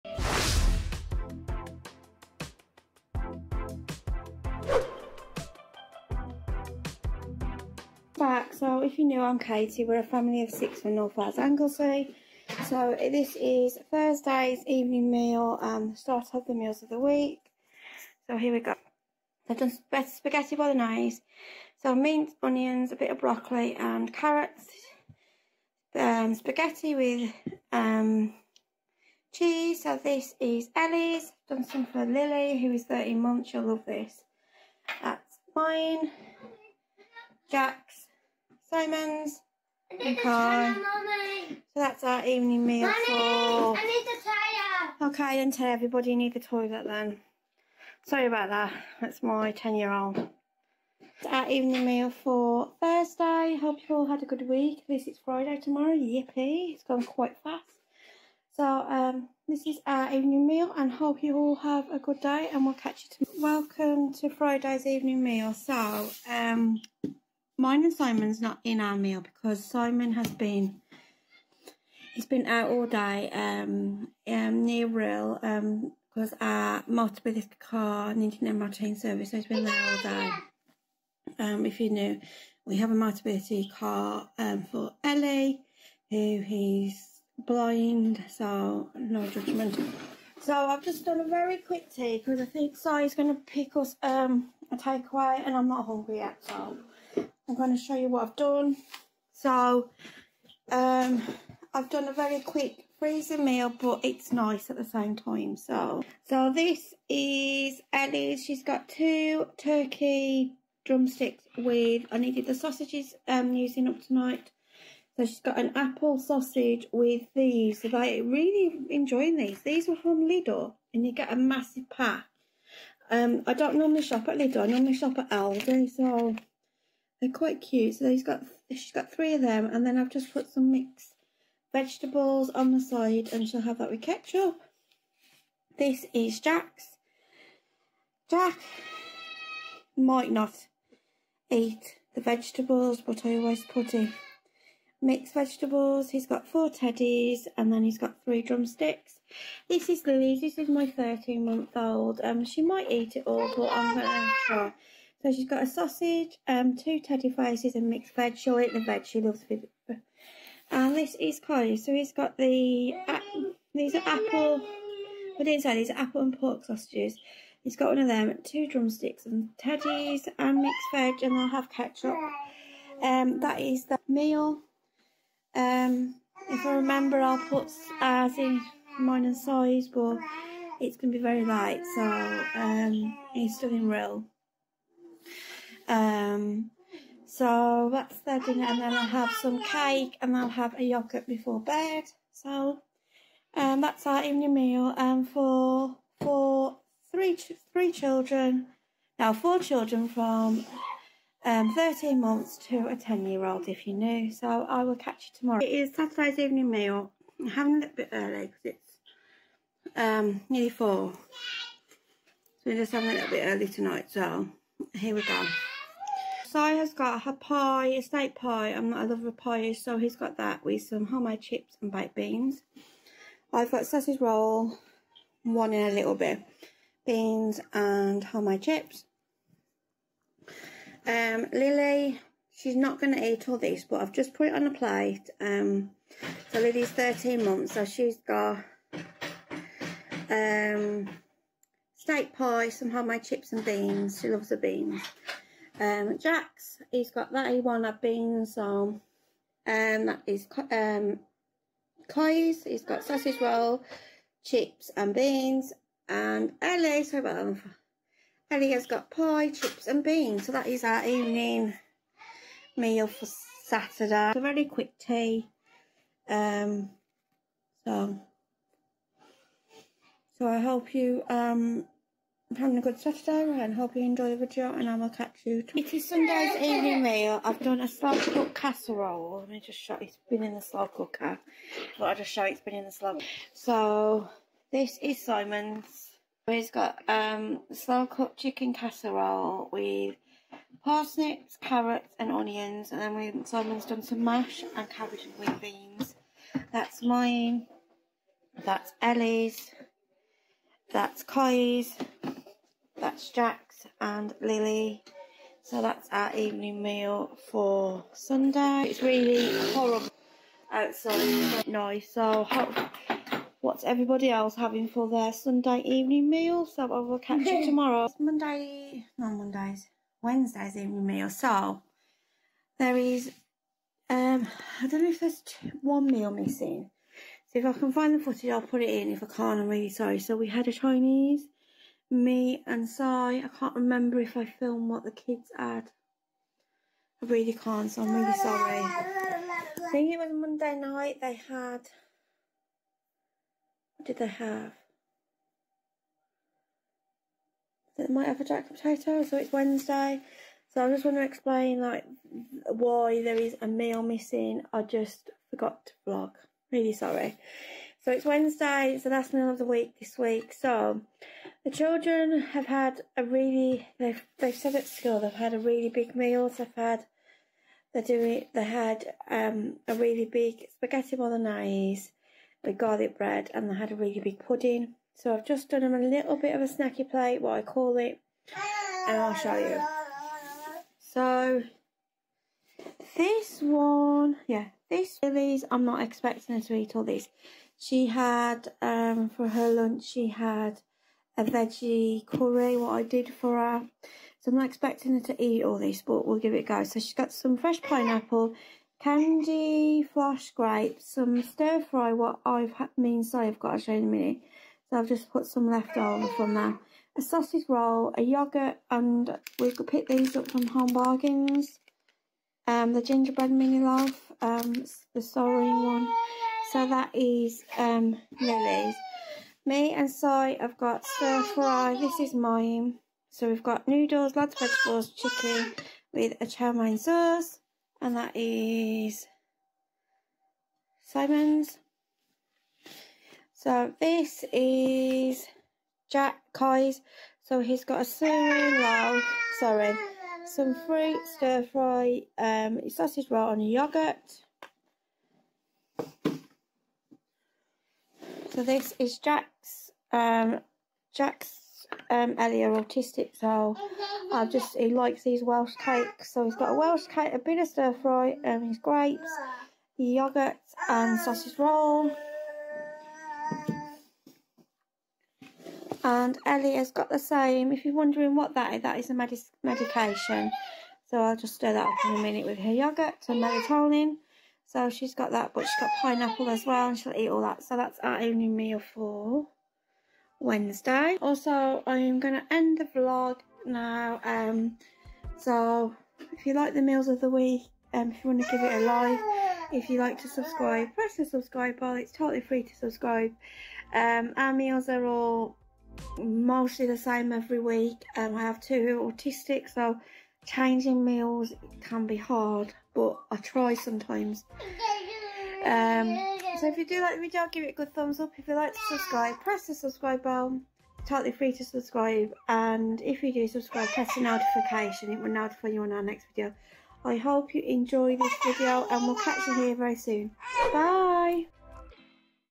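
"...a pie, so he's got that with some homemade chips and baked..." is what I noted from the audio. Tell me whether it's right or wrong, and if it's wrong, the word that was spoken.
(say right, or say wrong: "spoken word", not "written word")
right.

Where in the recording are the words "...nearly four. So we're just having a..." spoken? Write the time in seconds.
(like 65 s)
210 s.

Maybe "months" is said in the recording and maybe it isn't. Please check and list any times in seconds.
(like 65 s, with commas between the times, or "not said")
33 s, 151 s, 202 s, 237 s.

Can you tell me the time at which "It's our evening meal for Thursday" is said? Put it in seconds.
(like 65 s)
50 s.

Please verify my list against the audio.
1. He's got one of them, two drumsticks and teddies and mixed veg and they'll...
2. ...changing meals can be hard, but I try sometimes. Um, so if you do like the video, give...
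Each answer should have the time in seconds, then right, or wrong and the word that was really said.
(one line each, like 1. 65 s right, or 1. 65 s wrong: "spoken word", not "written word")
1. 167 s right
2. 500 s right.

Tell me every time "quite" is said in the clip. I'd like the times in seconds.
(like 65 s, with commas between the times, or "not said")
57 s, 127 s.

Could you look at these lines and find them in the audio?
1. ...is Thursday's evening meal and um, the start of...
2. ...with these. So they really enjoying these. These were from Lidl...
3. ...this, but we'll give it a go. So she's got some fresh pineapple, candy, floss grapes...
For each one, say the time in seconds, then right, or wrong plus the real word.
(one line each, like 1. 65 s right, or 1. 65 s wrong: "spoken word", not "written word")
1. 13 s right
2. 116 s right
3. 395 s right.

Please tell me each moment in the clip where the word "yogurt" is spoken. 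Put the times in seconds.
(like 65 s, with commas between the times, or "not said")
190 s, 408 s, 443 s, 459 s, 472 s.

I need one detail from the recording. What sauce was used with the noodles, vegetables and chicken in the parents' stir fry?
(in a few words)
chow mein sauce.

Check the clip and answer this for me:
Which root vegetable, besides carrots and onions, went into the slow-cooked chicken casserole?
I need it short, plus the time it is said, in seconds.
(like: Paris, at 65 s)
parsnips, at 290 s.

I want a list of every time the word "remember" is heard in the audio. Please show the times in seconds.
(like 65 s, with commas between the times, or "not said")
176 s, 333 s.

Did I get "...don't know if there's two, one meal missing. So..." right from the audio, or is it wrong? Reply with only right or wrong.
right.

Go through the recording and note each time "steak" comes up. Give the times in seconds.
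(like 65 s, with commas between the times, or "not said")
218 s, 241 s.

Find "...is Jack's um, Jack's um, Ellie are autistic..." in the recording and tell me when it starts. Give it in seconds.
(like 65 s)
448 s.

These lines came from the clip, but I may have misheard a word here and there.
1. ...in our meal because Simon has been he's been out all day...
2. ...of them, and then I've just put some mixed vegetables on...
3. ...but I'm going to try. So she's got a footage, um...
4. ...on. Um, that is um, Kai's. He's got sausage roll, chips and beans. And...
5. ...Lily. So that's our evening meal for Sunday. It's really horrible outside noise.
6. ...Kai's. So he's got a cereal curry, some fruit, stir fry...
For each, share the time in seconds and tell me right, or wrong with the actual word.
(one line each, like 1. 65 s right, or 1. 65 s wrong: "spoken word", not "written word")
1. 68 s right
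2. 129 s right
3. 153 s wrong: "sausage", not "footage"
4. 248 s right
5. 304 s right
6. 436 s wrong: "sorry", not "curry".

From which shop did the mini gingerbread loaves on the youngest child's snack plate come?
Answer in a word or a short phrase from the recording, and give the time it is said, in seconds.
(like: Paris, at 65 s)
Home Bargains, at 410 s.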